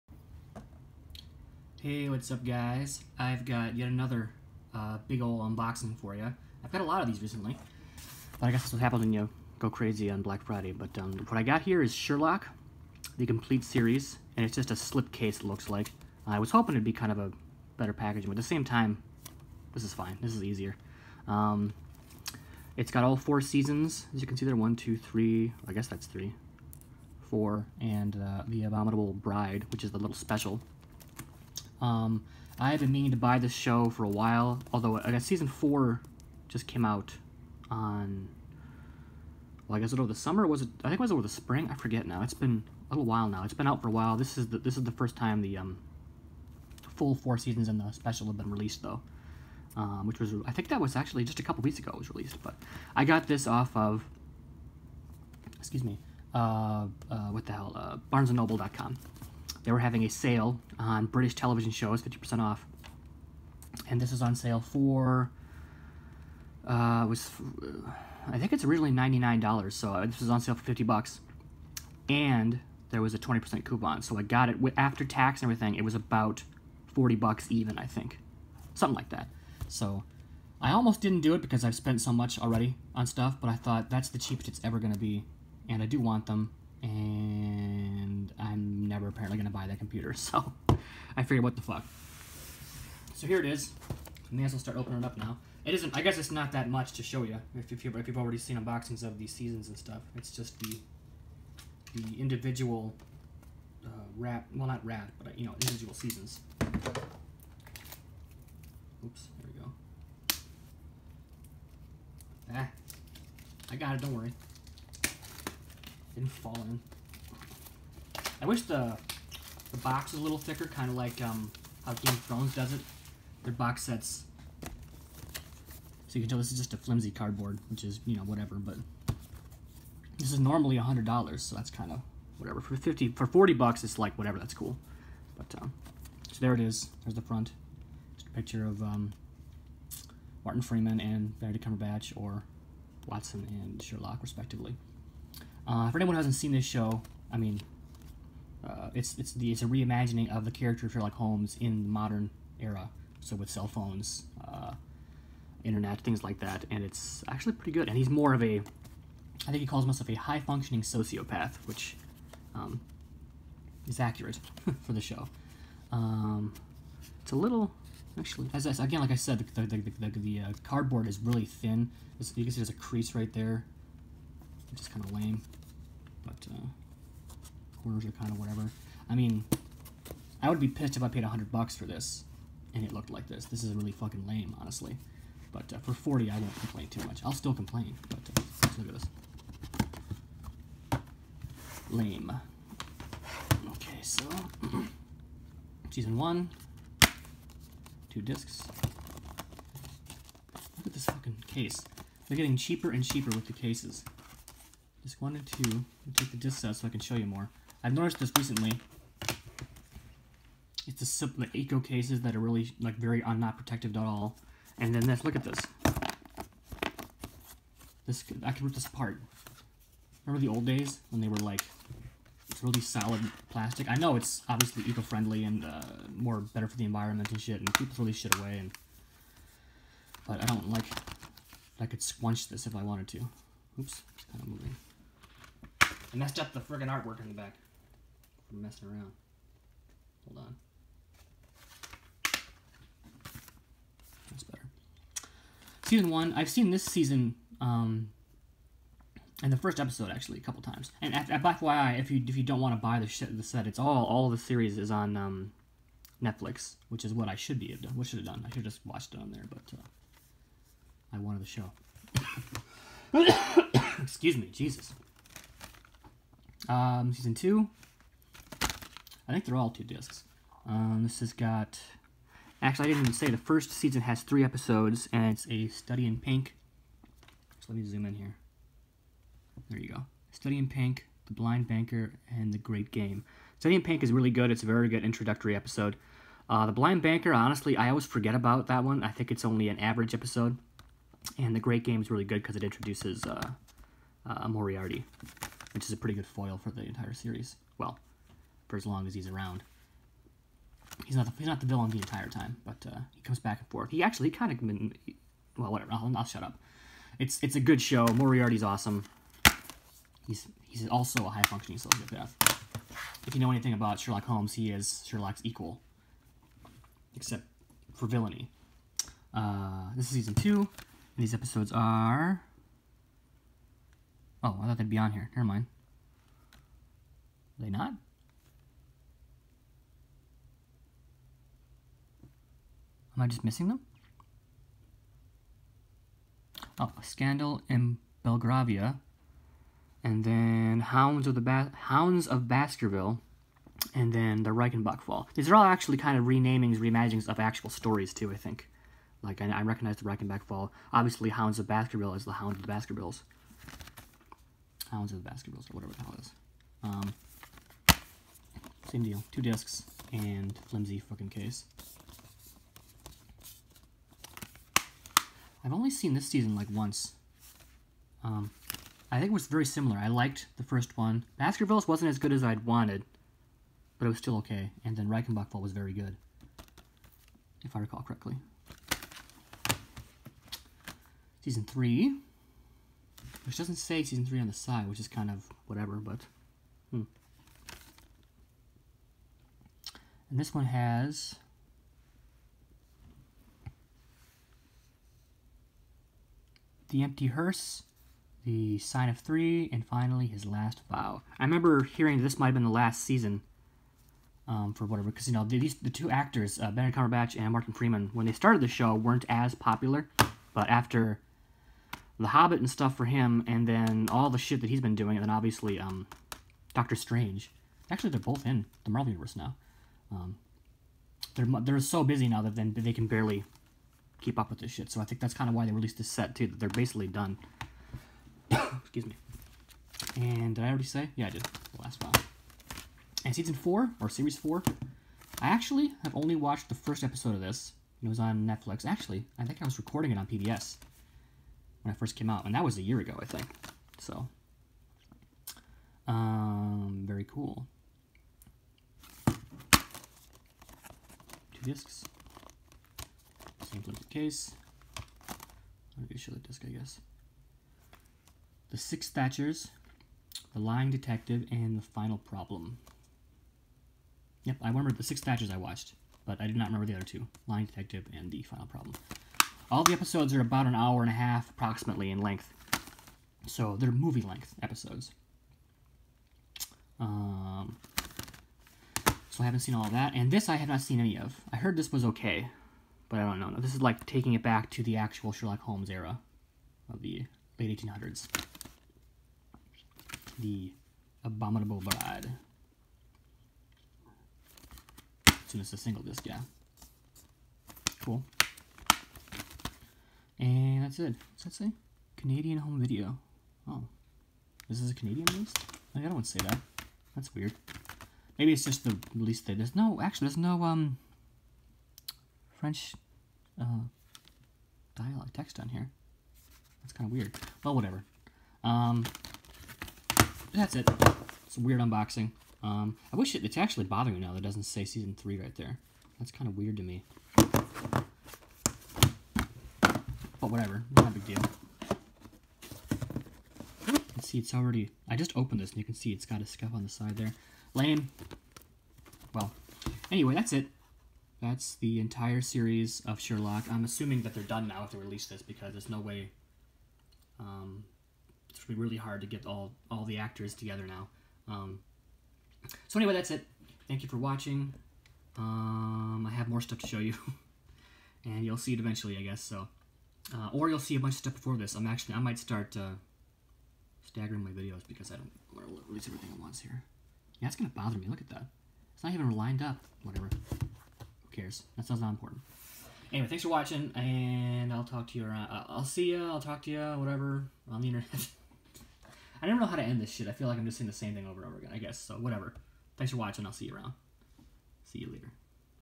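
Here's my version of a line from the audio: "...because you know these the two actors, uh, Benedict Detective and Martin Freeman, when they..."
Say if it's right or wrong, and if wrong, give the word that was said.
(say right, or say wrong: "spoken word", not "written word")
wrong: "Cumberbatch", not "Detective".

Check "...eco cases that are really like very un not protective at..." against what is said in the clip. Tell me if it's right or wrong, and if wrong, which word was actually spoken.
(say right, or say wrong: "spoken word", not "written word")
right.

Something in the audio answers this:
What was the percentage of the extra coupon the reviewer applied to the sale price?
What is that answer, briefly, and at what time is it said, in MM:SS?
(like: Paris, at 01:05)
20%, at 01:13.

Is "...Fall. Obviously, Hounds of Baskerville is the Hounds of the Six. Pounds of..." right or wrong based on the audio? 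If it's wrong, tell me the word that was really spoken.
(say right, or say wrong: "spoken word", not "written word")
wrong: "Baskervilles", not "Six".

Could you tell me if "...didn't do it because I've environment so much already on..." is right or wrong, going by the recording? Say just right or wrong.
wrong.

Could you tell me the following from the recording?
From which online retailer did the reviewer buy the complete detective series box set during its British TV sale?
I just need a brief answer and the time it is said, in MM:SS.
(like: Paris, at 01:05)
BarnesandNoble.com, at 00:58.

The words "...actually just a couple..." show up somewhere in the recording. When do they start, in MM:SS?
00:50.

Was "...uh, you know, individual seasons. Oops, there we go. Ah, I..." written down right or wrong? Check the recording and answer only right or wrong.
right.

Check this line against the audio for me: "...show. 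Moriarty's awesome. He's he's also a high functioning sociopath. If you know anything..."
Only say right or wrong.
right.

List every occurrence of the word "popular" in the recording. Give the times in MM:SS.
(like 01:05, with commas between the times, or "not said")
06:49.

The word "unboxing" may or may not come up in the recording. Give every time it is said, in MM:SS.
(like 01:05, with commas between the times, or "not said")
00:05, 01:38, 08:41.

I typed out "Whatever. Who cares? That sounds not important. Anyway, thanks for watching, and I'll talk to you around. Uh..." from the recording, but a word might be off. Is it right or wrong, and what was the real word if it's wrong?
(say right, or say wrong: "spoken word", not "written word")
right.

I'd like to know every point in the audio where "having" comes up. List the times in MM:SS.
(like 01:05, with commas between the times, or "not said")
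00:59.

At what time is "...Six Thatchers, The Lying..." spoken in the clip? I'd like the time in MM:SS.
07:38.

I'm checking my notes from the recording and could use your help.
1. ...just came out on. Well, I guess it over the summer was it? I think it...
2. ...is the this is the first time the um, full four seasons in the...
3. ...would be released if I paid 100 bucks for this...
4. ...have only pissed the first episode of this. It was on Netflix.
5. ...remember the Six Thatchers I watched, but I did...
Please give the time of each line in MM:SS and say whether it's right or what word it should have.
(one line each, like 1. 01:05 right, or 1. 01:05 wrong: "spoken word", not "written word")
1. 00:36 right
2. 00:44 right
3. 03:00 wrong: "pissed", not "released"
4. 07:16 wrong: "watched", not "pissed"
5. 07:44 right.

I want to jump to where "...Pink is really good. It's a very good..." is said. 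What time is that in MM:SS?
04:43.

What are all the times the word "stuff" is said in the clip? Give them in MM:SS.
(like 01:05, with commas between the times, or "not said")
01:23, 01:39, 06:52, 09:16, 09:21.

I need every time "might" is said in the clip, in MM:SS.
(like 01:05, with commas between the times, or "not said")
06:42, 09:22.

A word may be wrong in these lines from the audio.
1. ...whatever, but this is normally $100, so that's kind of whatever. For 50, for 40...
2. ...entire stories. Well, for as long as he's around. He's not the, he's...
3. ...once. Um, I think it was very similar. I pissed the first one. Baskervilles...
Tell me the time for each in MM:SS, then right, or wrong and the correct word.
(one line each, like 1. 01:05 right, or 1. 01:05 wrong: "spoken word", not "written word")
1. 02:08 right
2. 04:56 wrong: "series", not "stories"
3. 06:06 wrong: "liked", not "pissed".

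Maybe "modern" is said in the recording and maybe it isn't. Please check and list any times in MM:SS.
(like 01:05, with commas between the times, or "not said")
02:31.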